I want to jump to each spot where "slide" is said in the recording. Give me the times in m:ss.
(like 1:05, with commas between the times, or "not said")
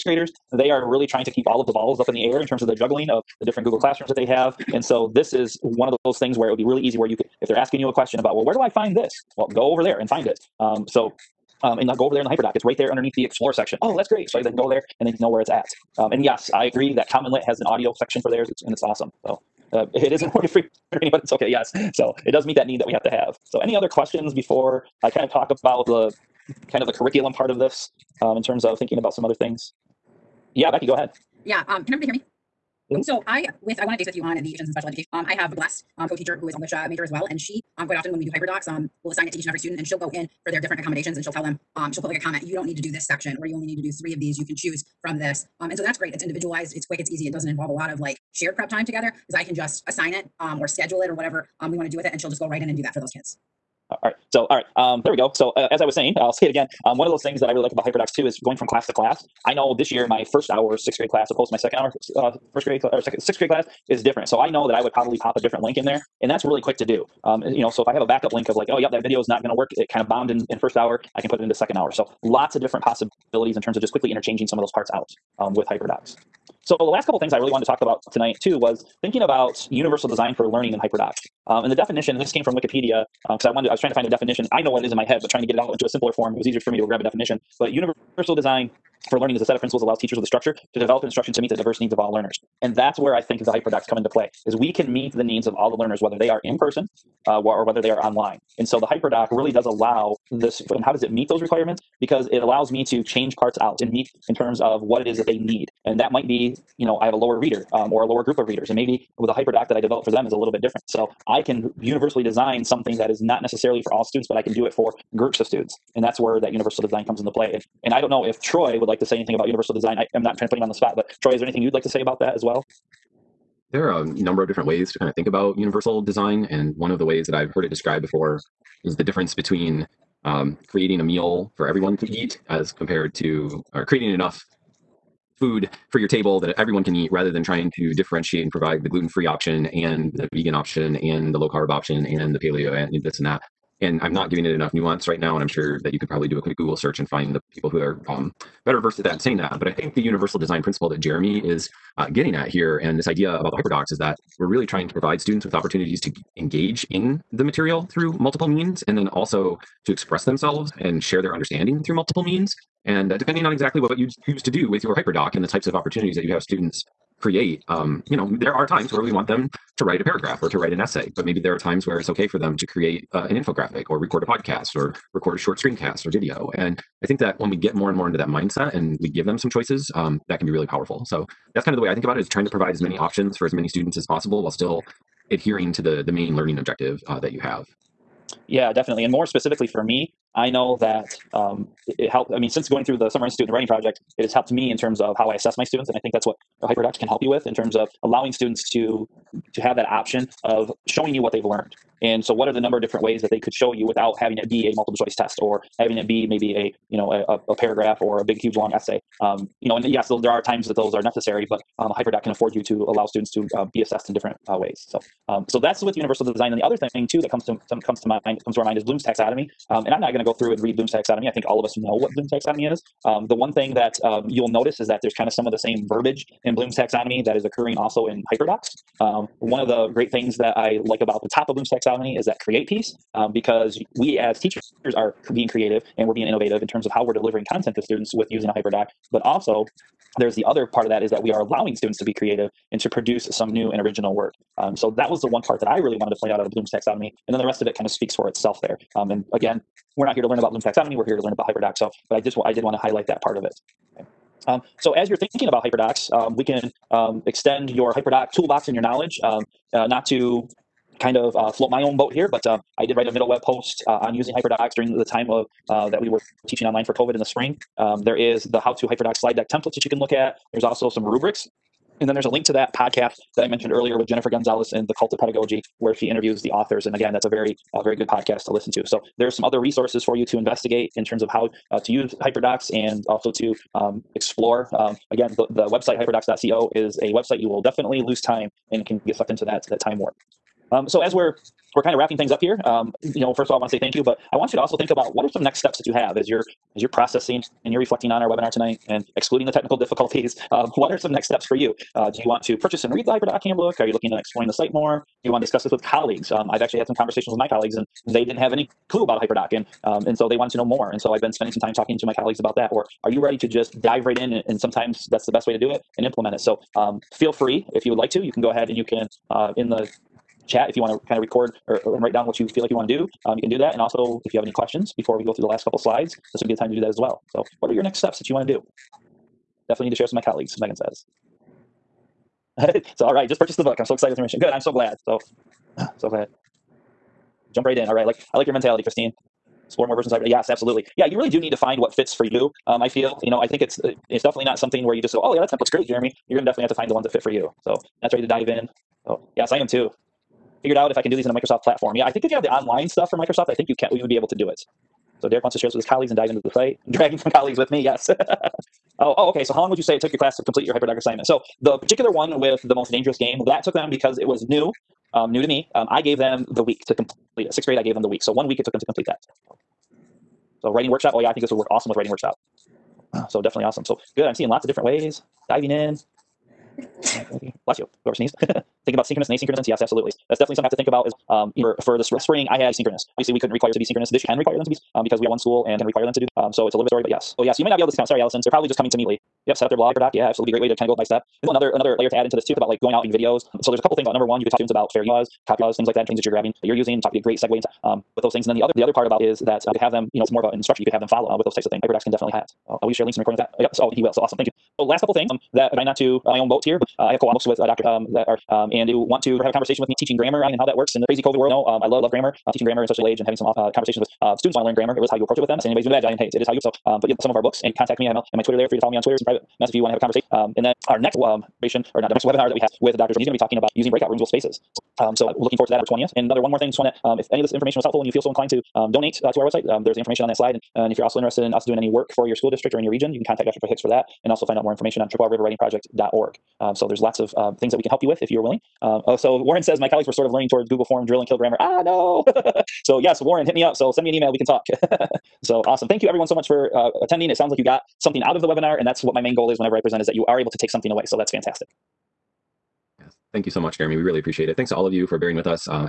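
4:29, 5:25, 7:10.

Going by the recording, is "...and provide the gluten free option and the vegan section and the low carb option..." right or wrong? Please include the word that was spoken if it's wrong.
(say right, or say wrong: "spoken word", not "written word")
wrong: "option", not "section".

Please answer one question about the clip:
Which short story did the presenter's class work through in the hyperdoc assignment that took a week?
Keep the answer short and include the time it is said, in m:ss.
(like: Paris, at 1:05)
The Most Dangerous Game, at 6:02.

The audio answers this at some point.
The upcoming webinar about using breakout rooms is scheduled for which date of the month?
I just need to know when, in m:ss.
7:05.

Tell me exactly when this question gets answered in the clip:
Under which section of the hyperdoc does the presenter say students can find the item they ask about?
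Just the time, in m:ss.
0:13.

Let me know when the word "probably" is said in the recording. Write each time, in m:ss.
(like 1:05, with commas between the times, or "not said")
1:04, 2:26, 6:28.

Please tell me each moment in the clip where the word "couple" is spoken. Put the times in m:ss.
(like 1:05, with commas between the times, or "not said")
1:17, 5:25, 6:33, 6:45.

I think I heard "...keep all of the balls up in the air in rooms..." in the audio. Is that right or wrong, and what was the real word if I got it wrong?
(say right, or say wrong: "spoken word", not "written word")
wrong: "terms", not "rooms".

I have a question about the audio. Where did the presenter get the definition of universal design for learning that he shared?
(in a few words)
Wikipedia.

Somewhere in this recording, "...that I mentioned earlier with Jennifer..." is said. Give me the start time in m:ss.
4:33.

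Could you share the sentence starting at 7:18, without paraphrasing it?
Um, oh, so Warren says my colleagues were sort of learning towards Google Form, drill, and kill grammar.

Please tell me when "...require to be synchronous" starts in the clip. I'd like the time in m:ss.
6:23.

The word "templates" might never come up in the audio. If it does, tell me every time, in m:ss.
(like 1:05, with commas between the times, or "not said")
4:29, 5:45.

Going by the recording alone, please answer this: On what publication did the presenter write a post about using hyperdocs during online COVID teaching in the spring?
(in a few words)
MiddleWeb.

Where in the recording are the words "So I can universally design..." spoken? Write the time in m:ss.
1:50.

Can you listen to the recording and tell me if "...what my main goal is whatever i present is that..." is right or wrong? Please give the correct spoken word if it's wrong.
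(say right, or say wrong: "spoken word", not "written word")
wrong: "whenever", not "whatever".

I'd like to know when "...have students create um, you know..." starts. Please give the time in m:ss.
2:46.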